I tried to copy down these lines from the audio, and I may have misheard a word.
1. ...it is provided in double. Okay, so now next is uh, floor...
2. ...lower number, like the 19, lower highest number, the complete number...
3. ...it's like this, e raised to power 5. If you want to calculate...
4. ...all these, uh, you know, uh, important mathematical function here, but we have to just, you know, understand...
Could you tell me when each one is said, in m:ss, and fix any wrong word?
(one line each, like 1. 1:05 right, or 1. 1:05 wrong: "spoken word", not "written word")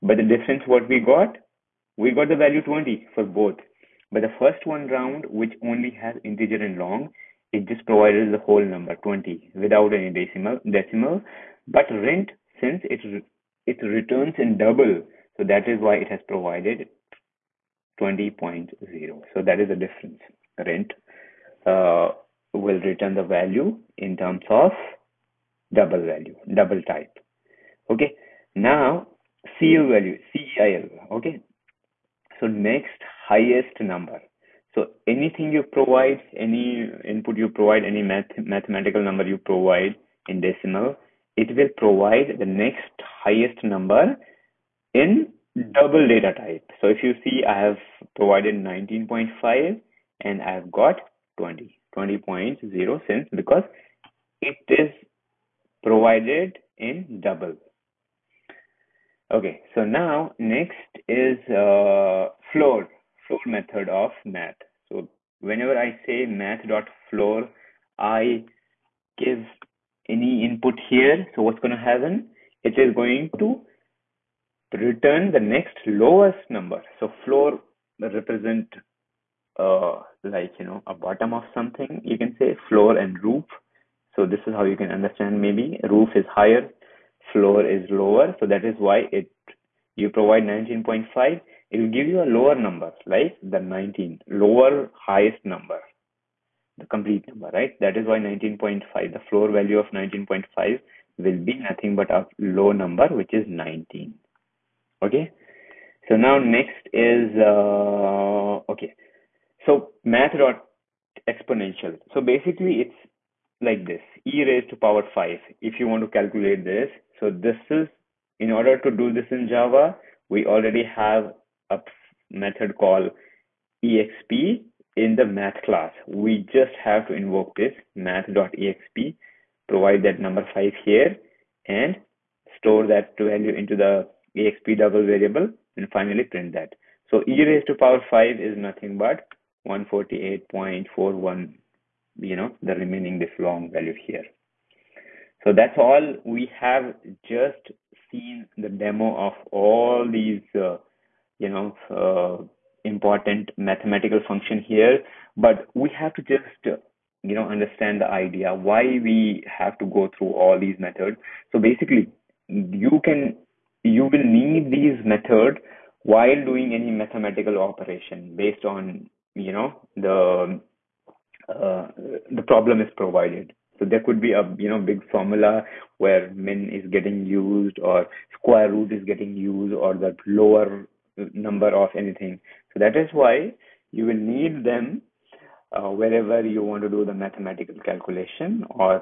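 1. 0:54 right
2. 1:32 right
3. 1:52 right
4. 2:29 right.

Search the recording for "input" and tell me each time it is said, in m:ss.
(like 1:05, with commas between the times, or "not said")
0:37, 1:10.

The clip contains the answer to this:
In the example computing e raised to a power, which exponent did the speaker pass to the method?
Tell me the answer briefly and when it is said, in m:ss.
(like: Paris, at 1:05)
5, at 2:10.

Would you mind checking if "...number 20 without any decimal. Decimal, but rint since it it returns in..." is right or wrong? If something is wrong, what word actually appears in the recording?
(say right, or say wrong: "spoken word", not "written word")
right.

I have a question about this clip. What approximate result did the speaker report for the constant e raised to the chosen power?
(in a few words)
148.41.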